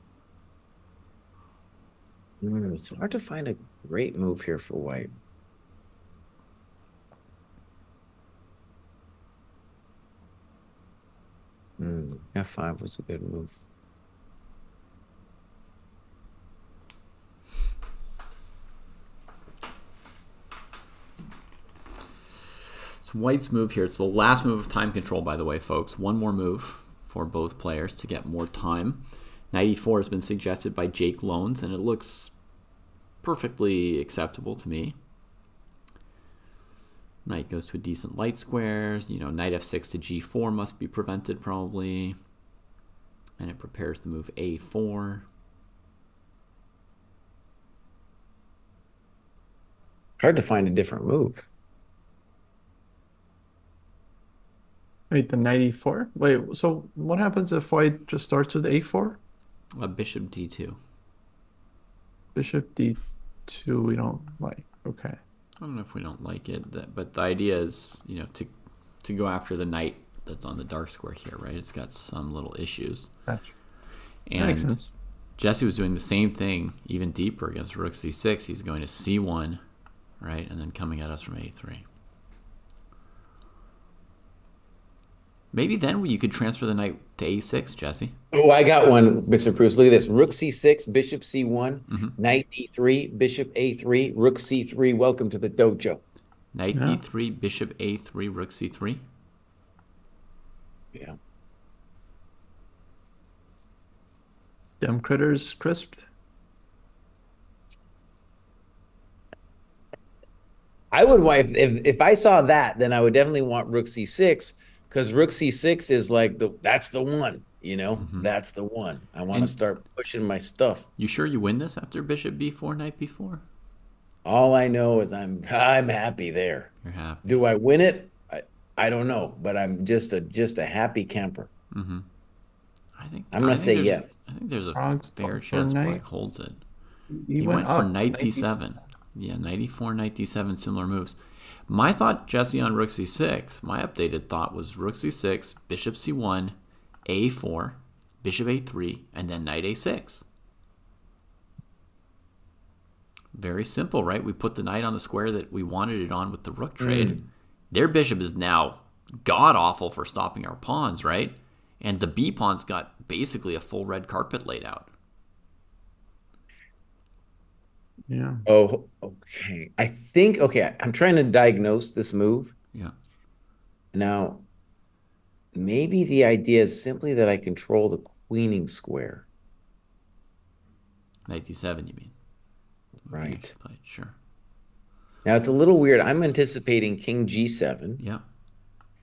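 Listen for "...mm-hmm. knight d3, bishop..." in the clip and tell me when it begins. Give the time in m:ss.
1:31.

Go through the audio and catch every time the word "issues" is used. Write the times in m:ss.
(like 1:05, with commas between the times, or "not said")
1:12.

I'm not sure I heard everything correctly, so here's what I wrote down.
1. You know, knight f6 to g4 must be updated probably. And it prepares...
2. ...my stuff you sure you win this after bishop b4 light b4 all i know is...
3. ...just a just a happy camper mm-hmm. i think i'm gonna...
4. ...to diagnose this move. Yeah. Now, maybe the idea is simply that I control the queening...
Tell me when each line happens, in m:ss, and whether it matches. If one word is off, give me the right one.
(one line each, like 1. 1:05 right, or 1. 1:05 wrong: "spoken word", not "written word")
1. 0:39 wrong: "prevented", not "updated"
2. 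2:00 wrong: "knight", not "light"
3. 2:09 right
4. 2:51 right.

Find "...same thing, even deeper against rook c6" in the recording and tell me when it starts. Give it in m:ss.
1:16.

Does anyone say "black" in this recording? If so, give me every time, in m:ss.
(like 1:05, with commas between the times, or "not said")
2:15.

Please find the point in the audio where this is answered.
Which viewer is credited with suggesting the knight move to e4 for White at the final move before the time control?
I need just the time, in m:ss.
0:30.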